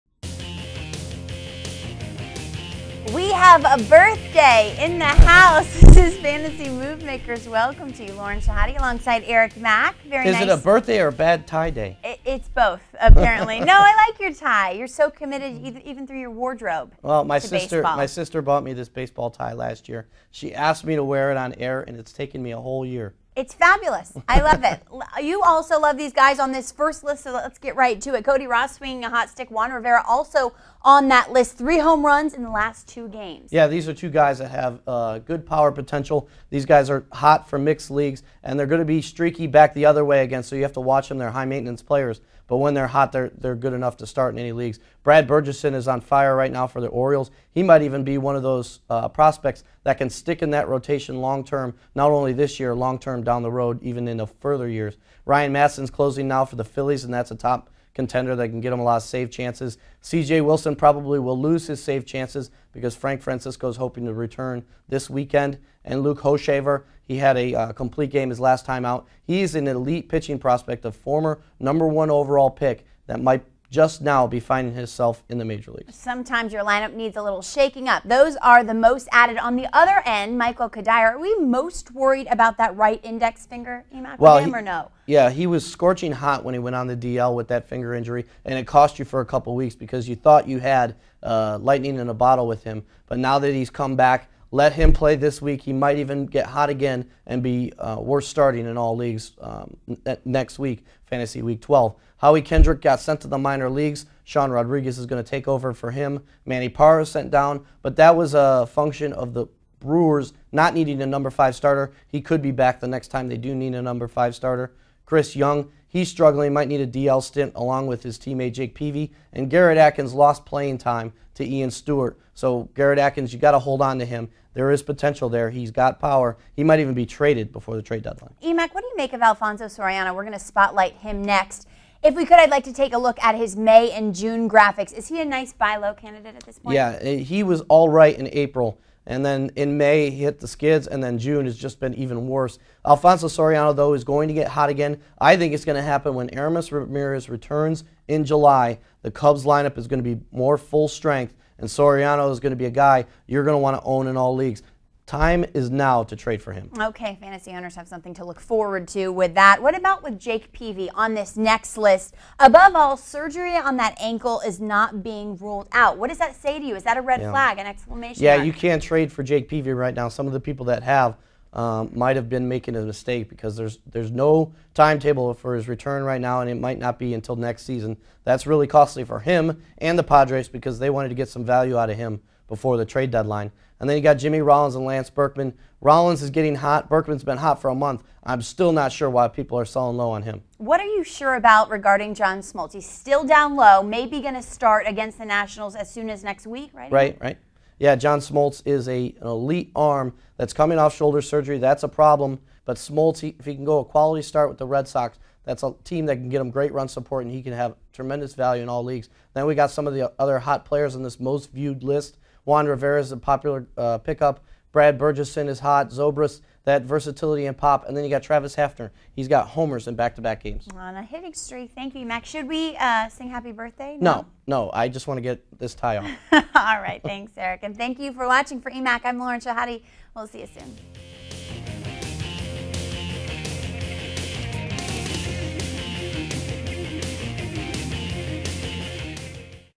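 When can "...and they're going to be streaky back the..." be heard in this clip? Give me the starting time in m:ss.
0:38.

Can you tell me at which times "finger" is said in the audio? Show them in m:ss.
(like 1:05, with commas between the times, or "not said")
1:23, 1:27.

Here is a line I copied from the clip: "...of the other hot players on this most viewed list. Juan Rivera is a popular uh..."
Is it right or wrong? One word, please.
right.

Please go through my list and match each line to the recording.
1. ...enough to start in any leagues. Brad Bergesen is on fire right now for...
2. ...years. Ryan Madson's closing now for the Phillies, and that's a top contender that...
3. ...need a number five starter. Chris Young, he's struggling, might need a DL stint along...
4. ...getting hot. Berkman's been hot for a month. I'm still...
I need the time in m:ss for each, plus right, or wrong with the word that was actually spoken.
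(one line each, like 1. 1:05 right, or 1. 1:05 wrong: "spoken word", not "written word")
1. 0:43 right
2. 0:54 right
3. 1:53 right
4. 3:06 right.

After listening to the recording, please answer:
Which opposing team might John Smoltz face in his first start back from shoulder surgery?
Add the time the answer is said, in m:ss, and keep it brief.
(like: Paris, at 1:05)
The Nationals, at 3:15.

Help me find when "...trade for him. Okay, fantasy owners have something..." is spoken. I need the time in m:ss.
2:36.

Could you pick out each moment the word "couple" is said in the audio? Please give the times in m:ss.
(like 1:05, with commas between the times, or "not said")
1:29.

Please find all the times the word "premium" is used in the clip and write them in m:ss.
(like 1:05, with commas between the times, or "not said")
not said.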